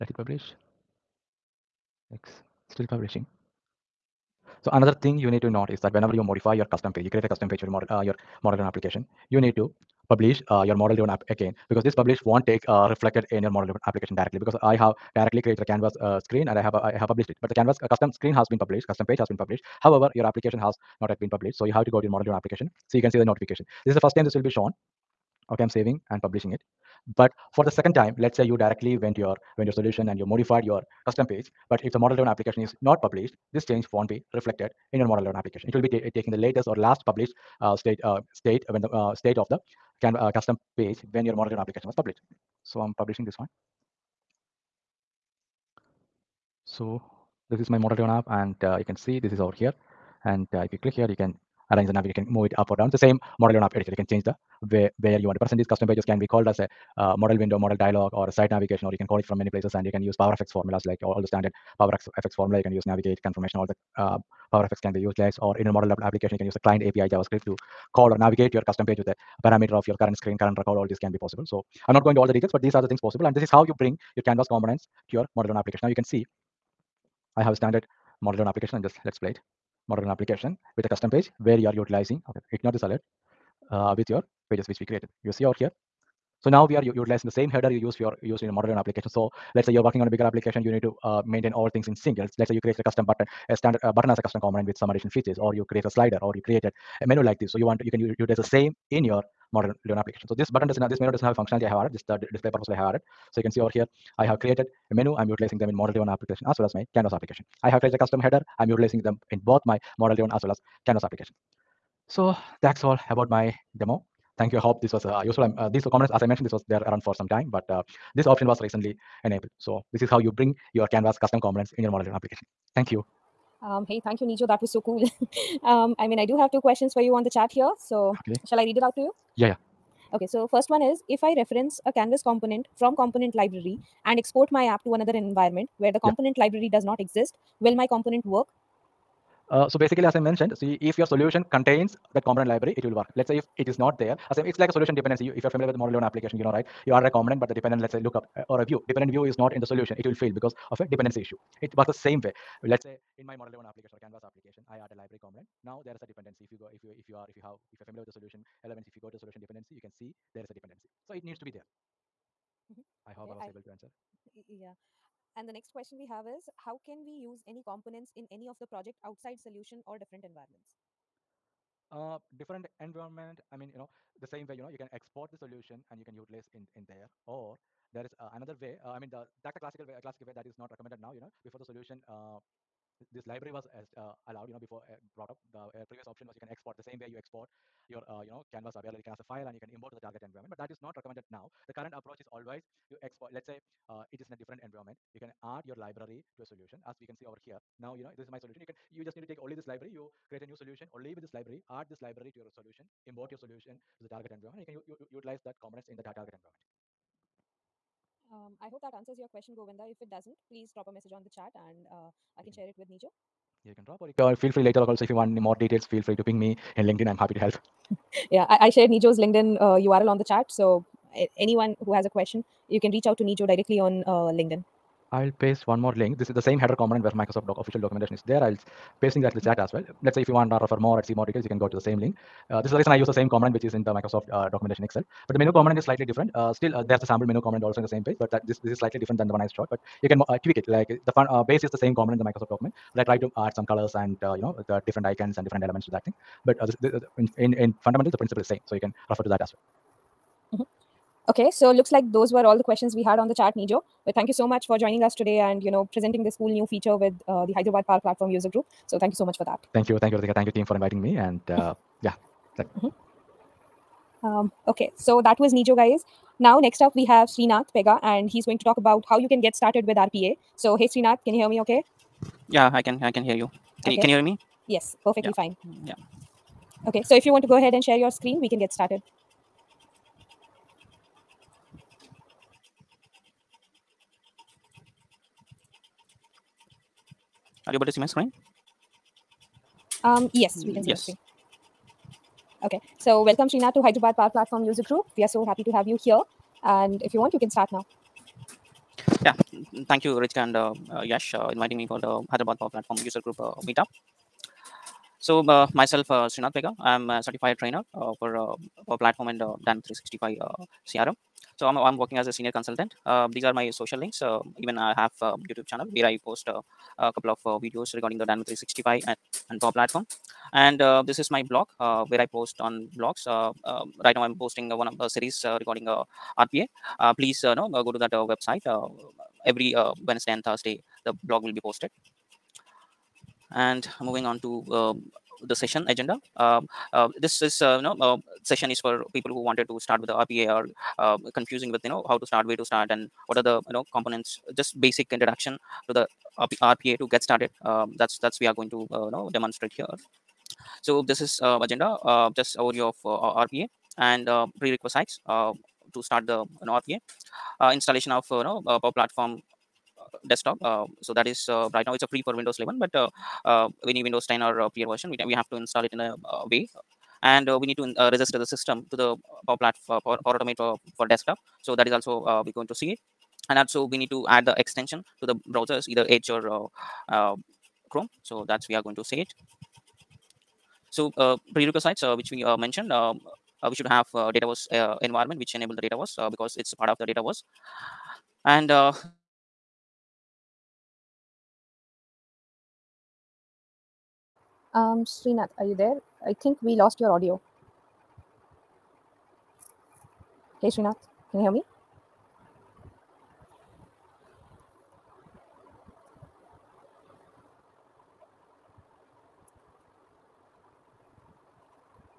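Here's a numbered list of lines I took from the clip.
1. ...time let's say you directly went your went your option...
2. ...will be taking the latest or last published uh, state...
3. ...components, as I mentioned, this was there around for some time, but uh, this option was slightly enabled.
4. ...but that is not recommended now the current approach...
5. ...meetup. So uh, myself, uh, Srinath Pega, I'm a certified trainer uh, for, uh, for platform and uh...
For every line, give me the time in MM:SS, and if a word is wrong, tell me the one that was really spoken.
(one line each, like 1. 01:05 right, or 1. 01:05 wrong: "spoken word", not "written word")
1. 00:27 wrong: "solution", not "option"
2. 00:35 right
3. 01:55 wrong: "recently", not "slightly"
4. 03:10 right
5. 05:03 right.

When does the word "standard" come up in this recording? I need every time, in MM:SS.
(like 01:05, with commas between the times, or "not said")
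01:01, 01:17, 01:33.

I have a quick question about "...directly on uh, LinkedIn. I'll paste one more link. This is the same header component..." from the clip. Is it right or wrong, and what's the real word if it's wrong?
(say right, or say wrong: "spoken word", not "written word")
right.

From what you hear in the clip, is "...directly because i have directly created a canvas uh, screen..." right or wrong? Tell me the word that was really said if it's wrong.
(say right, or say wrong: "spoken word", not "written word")
right.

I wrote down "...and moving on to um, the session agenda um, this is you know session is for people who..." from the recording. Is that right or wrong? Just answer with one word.
right.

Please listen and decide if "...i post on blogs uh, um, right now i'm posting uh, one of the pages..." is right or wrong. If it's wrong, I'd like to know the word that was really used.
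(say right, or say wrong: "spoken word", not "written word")
wrong: "series", not "pages".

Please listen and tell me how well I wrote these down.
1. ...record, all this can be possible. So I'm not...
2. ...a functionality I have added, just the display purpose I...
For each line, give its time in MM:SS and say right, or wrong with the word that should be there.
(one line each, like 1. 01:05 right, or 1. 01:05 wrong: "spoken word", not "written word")
1. 01:10 right
2. 01:41 right.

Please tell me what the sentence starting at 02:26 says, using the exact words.
You are a component, but the dependent, let's say, lookup uh, or a view.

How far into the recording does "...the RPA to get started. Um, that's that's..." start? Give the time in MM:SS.
05:45.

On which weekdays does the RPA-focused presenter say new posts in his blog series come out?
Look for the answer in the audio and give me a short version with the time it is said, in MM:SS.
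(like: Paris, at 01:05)
Wednesday and Thursday, at 05:30.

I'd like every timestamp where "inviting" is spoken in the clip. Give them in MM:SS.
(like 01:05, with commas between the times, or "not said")
04:20, 05:01.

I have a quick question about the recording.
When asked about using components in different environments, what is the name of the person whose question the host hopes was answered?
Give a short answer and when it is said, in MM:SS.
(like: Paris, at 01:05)
Govinda, at 03:29.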